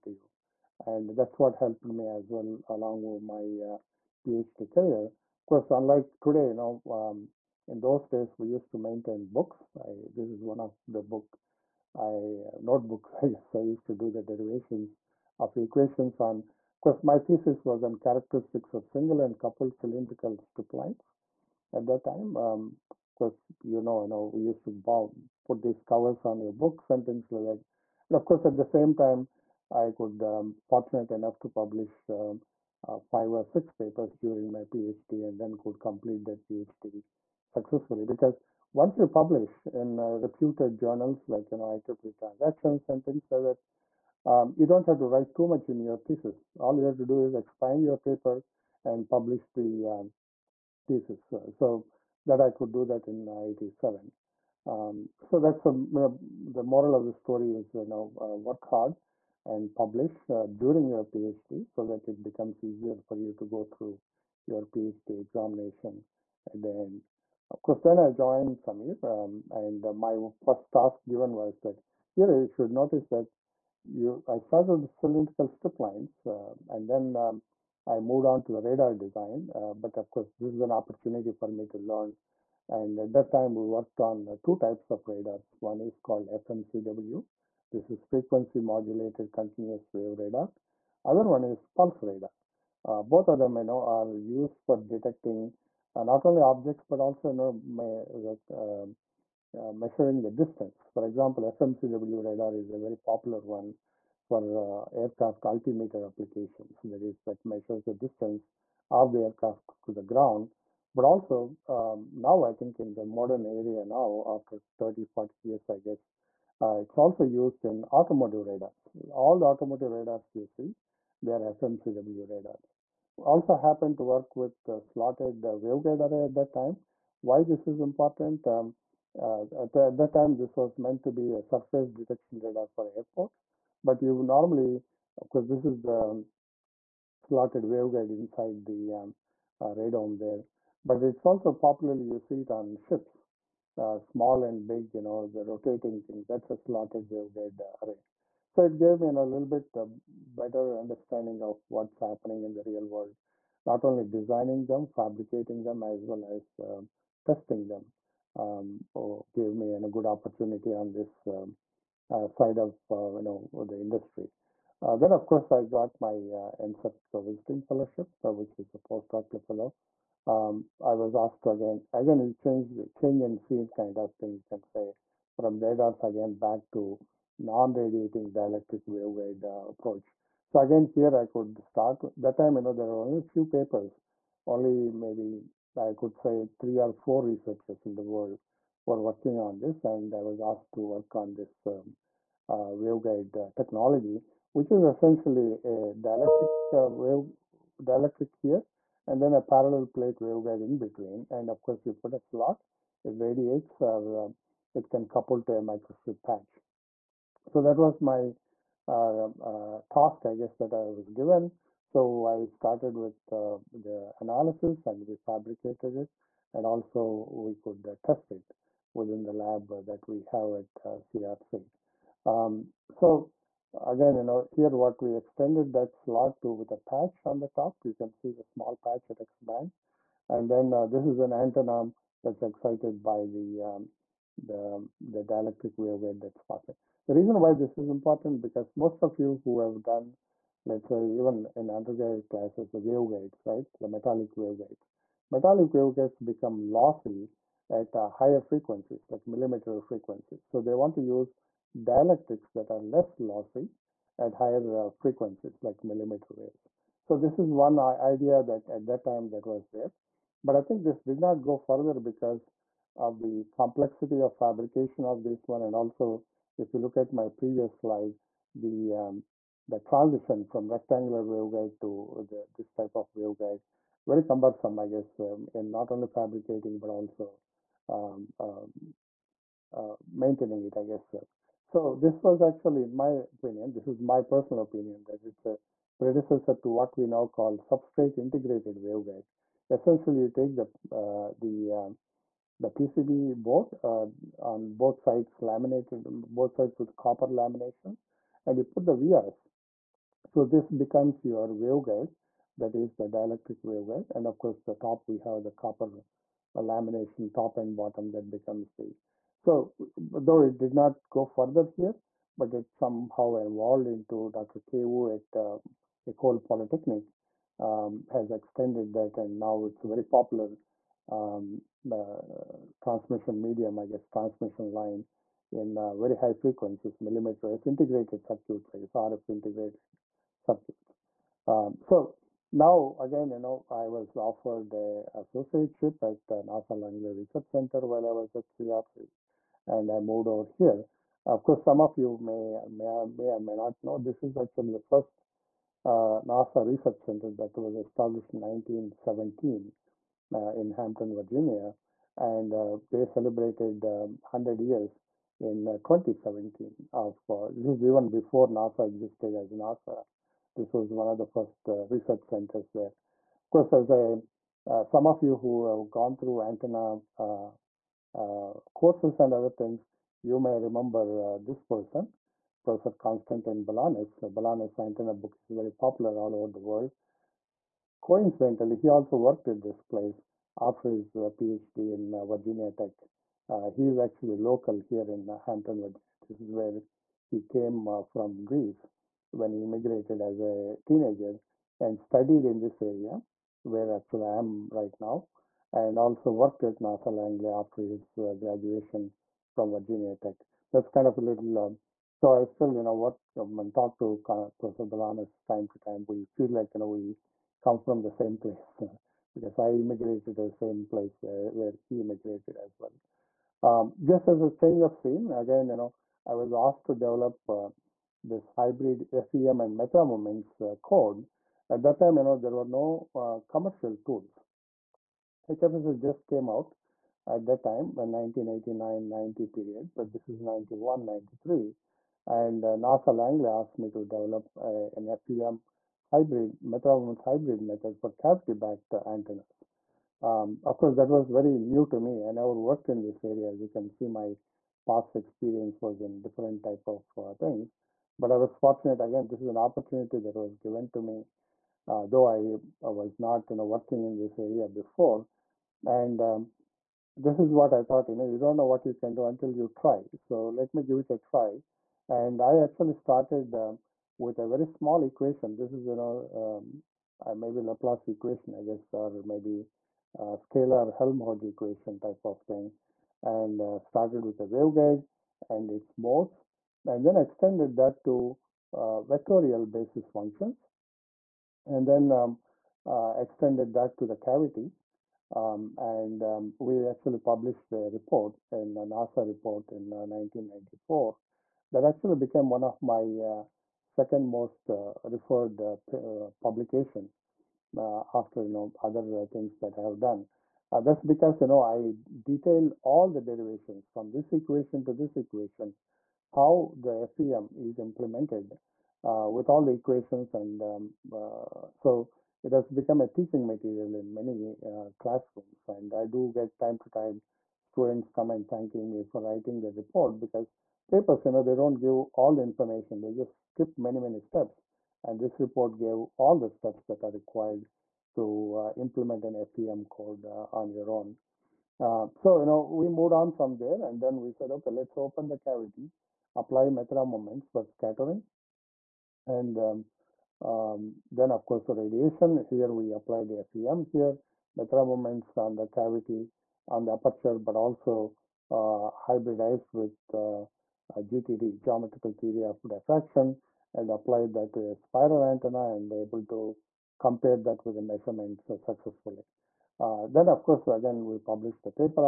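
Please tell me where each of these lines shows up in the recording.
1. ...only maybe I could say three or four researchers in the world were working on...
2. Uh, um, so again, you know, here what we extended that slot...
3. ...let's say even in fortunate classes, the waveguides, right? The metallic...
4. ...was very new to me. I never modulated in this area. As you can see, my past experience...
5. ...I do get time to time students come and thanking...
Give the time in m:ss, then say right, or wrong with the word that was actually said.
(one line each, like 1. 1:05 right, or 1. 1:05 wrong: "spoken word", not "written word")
1. 3:04 right
2. 3:42 right
3. 4:00 wrong: "undergraduate", not "fortunate"
4. 7:21 wrong: "worked", not "modulated"
5. 8:35 right.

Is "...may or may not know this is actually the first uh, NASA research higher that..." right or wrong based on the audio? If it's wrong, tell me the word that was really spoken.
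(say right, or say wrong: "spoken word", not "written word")
wrong: "center", not "higher".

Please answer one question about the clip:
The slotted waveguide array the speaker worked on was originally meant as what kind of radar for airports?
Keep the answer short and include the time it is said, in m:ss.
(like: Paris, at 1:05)
Surface detection radar, at 2:11.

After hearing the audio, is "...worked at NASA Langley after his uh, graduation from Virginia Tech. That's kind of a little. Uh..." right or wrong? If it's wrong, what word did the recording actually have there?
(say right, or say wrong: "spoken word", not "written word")
right.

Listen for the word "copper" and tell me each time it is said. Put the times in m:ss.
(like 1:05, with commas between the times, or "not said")
4:56, 5:05.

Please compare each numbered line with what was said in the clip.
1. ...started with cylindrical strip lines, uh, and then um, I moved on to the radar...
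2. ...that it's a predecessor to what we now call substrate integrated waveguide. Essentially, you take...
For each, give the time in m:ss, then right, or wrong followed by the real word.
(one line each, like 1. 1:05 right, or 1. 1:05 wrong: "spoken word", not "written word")
1. 1:14 right
2. 4:45 right.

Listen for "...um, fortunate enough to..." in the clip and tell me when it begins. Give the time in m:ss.
0:30.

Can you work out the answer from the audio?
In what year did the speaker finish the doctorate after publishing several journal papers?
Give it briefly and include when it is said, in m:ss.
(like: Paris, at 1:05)
1987, at 0:53.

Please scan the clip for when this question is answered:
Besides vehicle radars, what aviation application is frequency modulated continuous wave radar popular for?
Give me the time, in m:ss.
1:44.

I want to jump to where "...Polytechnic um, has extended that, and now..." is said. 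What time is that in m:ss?
5:16.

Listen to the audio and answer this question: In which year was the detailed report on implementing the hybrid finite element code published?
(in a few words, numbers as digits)
1994.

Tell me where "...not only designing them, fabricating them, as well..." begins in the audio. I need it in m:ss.
2:33.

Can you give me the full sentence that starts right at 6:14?
Balanis antenna book is very popular all over the world.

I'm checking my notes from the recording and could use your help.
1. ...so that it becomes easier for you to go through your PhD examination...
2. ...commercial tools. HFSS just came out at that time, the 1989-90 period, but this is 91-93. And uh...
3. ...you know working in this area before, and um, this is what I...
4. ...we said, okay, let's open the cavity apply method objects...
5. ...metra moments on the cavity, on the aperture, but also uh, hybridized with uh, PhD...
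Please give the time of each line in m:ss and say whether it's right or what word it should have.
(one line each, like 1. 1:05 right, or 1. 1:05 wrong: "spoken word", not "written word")
1. 1:01 right
2. 7:03 right
3. 7:33 right
4. 8:54 wrong: "moments", not "objects"
5. 9:04 wrong: "GTD", not "PhD".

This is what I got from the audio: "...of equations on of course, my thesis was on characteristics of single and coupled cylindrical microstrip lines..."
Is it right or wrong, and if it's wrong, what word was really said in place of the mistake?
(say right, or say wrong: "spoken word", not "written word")
wrong: "strip", not "microstrip".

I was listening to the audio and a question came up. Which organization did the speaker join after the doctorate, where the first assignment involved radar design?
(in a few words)
SAMEER.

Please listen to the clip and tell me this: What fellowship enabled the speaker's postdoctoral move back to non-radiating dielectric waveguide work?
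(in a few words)
NSERC visiting fellowship.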